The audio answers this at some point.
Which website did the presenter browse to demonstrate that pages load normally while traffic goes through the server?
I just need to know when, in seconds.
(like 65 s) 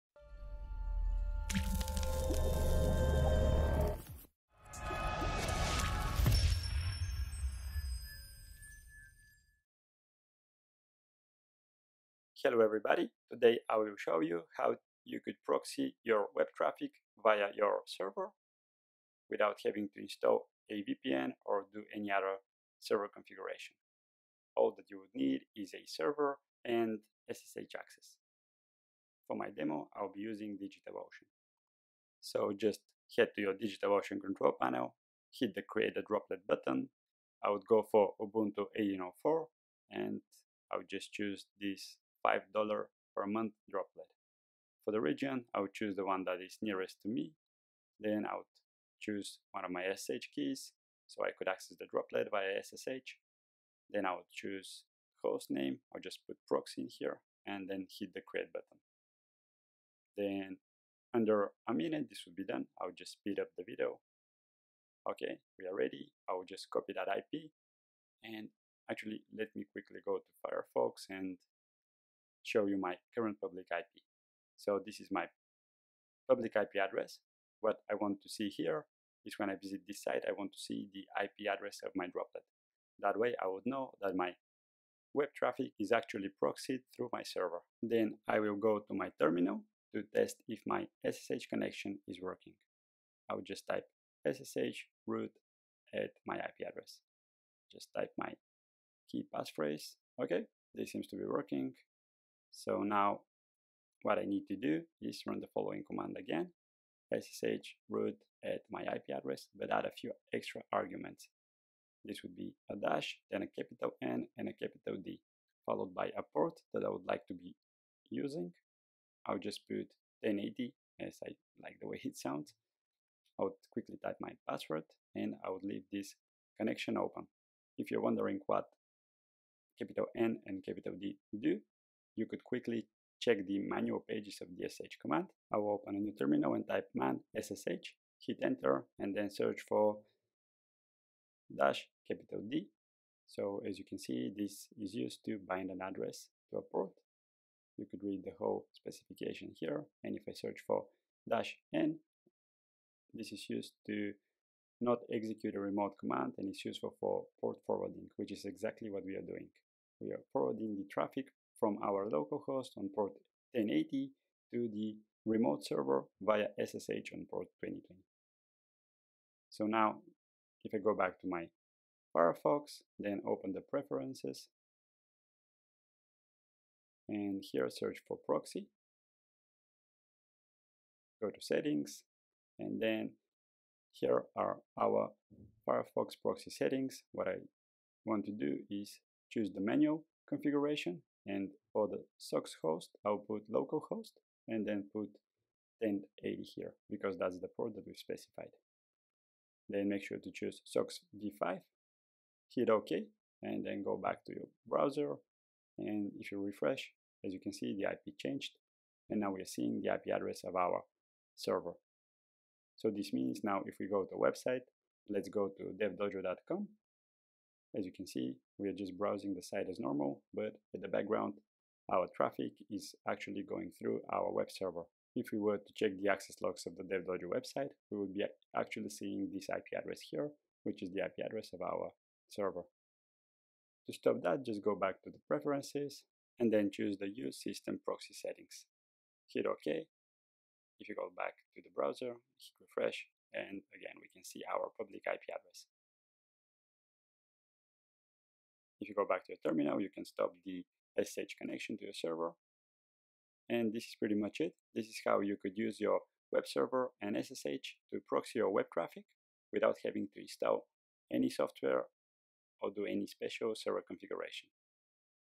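215 s.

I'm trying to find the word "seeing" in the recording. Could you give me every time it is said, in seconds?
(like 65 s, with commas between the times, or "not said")
209 s, 228 s.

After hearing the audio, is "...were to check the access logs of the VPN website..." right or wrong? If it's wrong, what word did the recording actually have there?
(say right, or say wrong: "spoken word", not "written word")
wrong: "DevDojo", not "VPN".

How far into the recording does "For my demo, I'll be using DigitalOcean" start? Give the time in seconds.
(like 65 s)
29 s.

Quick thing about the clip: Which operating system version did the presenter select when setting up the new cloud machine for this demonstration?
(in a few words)
Ubuntu 18.04.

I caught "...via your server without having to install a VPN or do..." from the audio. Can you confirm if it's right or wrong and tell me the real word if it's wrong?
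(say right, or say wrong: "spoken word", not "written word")
right.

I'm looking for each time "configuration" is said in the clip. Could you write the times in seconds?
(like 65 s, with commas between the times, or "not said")
23 s, 190 s, 263 s.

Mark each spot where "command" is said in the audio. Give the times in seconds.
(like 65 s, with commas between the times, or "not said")
105 s, 135 s, 155 s.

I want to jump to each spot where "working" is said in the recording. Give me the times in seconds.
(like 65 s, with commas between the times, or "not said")
92 s, 101 s.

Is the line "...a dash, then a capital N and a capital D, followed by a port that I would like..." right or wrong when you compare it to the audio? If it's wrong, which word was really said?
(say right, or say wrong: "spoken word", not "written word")
right.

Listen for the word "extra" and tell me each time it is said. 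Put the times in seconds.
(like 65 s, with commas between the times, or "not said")
110 s.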